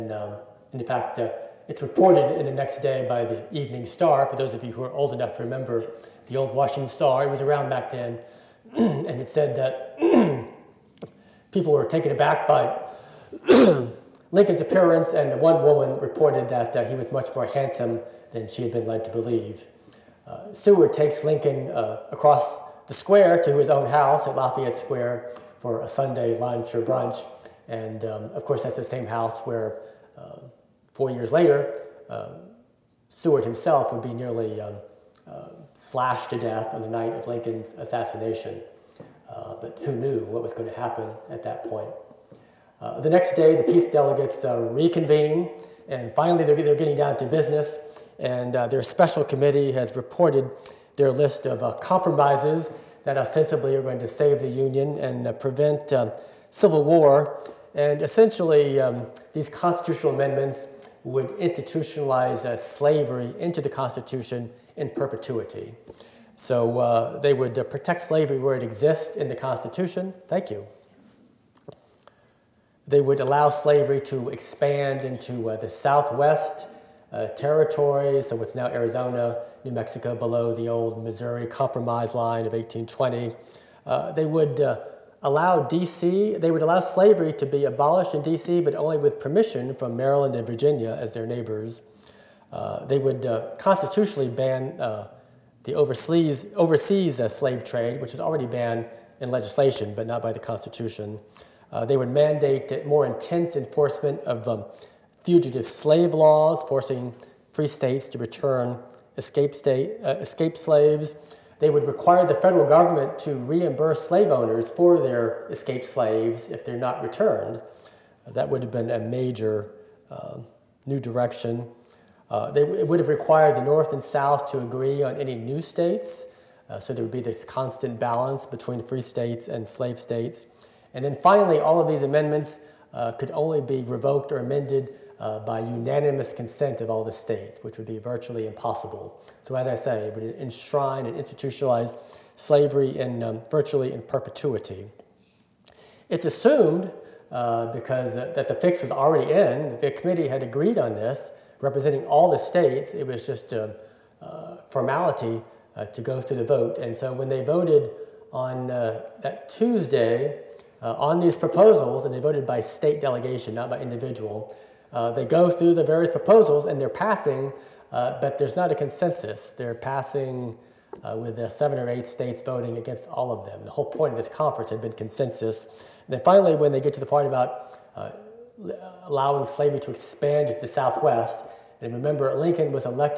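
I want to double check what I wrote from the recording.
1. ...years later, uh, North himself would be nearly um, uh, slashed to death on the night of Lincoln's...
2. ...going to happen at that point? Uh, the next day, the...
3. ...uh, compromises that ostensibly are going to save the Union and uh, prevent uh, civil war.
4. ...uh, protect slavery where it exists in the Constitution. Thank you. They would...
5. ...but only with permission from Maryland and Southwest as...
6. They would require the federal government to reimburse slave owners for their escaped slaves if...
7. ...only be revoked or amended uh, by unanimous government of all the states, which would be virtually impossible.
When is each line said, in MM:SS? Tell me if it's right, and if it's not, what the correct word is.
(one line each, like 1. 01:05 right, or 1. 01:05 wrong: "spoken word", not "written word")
1. 00:31 wrong: "Seward", not "North"
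2. 00:40 right
3. 00:51 right
4. 01:07 right
5. 01:28 wrong: "Virginia", not "Southwest"
6. 01:51 right
7. 02:13 wrong: "consent", not "government".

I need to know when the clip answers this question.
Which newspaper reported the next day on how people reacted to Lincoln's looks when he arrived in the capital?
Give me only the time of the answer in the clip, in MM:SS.
00:03.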